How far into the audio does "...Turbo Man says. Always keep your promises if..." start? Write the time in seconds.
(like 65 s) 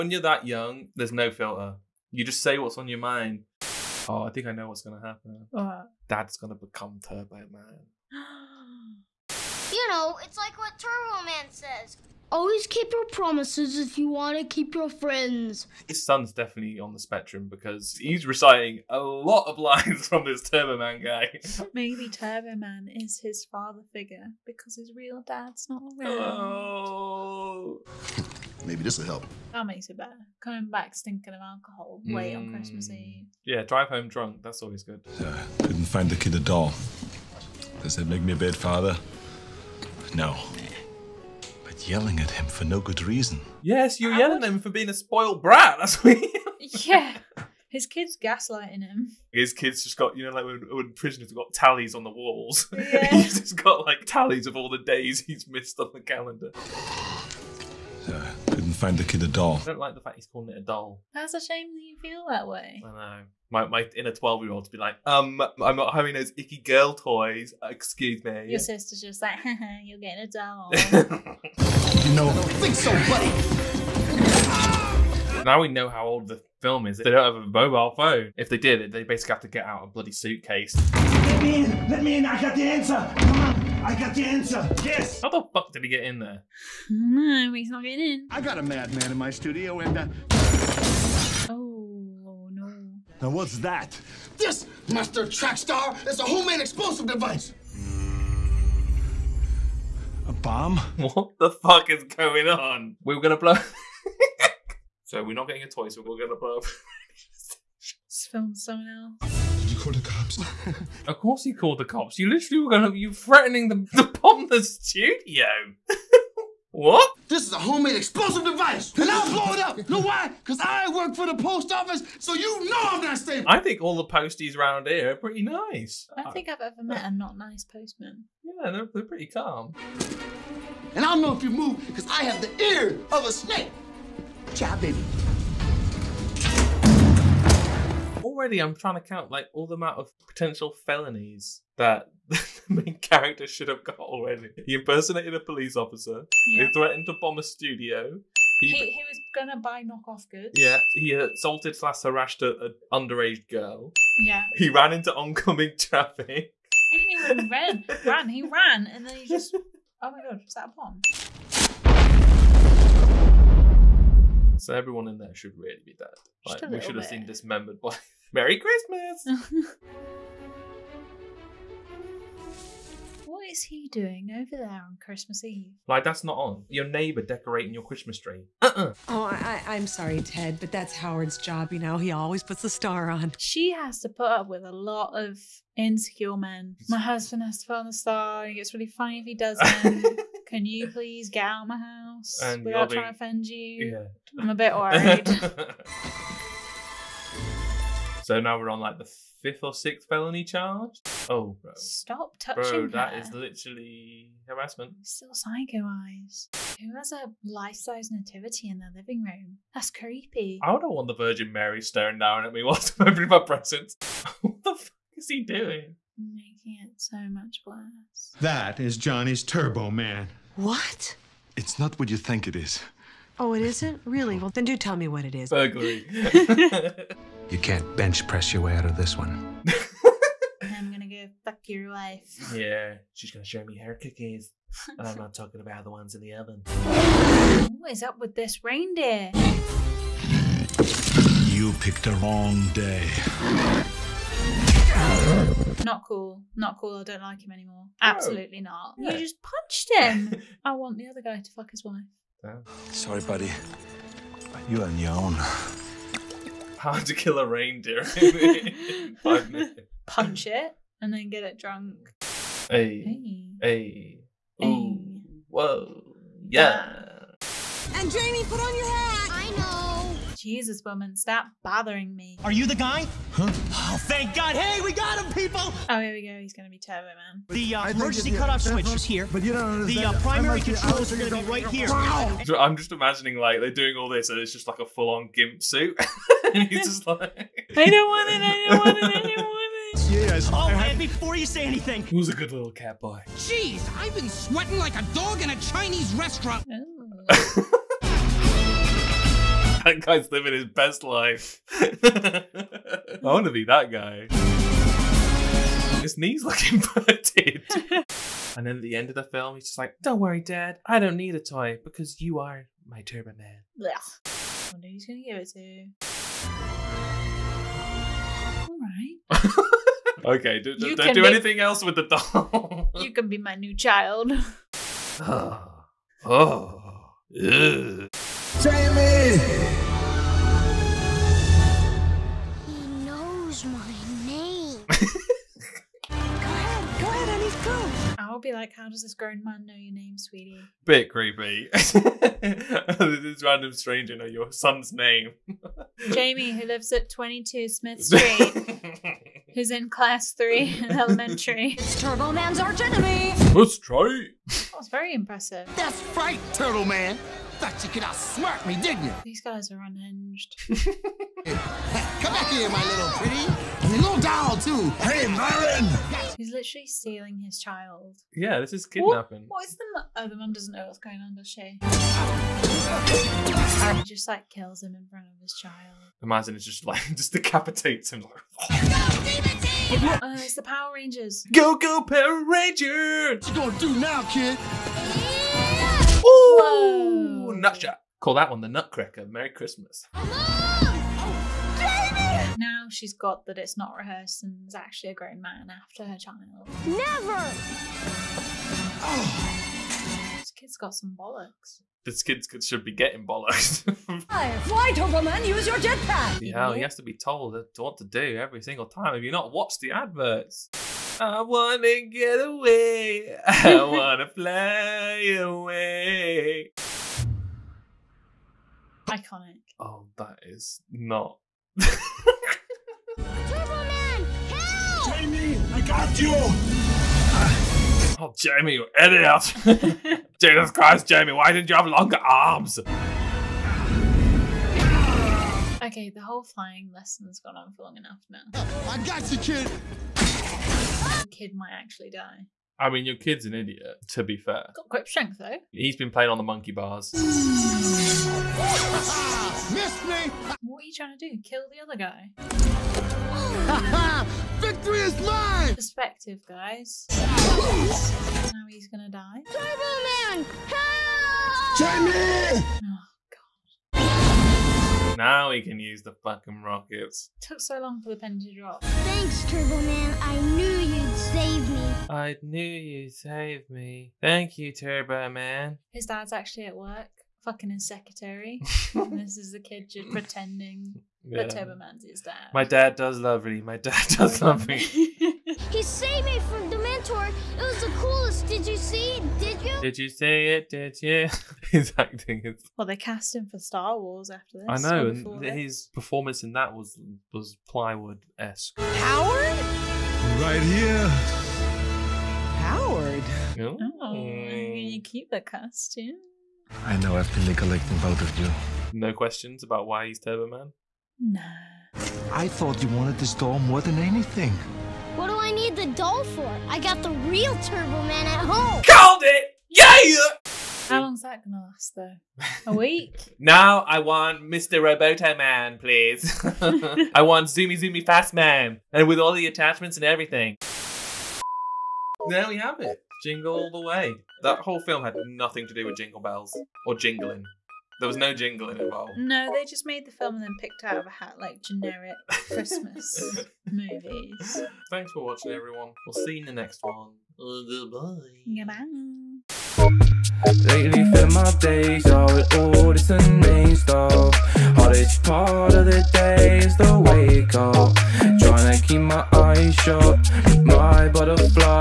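10 s.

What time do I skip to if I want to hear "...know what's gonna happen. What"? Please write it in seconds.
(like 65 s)
4 s.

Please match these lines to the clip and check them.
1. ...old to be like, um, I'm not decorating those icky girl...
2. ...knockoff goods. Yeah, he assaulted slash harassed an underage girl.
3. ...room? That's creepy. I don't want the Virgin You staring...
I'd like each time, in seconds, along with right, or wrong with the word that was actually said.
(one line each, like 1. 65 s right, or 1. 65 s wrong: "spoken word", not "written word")
1. 64 s wrong: "having", not "decorating"
2. 149 s right
3. 209 s wrong: "Mary", not "You".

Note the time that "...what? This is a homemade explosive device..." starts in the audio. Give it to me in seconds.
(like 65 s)
116 s.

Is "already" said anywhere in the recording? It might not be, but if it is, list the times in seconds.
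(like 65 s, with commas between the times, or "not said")
138 s, 143 s.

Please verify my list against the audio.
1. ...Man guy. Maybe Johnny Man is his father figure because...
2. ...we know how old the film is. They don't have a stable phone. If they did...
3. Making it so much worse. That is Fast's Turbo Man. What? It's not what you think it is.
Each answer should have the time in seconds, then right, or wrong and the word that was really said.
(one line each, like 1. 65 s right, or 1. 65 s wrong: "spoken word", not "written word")
1. 20 s wrong: "Turbo", not "Johnny"
2. 75 s wrong: "mobile", not "stable"
3. 216 s wrong: "Johnny", not "Fast".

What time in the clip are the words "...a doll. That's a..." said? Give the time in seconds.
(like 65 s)
60 s.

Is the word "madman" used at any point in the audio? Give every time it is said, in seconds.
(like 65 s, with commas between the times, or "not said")
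88 s.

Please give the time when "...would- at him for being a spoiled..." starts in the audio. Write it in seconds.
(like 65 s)
44 s.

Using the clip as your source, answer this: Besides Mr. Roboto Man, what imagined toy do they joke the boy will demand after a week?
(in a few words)
Zoomy Zoomy Fast Man.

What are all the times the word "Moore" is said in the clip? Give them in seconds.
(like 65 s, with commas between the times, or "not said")
not said.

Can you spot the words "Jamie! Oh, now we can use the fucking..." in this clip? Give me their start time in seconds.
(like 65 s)
461 s.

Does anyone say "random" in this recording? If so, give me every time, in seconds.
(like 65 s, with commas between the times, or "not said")
343 s.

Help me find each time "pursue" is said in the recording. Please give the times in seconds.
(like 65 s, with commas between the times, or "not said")
not said.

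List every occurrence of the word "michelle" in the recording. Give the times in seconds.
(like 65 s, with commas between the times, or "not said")
not said.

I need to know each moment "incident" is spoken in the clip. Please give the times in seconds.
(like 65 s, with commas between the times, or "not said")
not said.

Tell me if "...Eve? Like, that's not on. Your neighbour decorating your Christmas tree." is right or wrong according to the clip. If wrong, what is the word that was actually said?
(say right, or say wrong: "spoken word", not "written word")
right.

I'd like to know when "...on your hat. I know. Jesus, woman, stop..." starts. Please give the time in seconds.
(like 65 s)
268 s.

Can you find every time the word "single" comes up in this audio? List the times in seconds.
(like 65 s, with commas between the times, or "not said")
408 s.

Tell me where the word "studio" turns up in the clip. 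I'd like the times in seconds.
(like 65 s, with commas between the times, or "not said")
89 s, 114 s, 147 s.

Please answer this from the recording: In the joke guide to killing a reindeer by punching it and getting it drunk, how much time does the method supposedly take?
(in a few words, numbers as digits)
5 minutes.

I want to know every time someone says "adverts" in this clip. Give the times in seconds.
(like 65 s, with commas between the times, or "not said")
409 s.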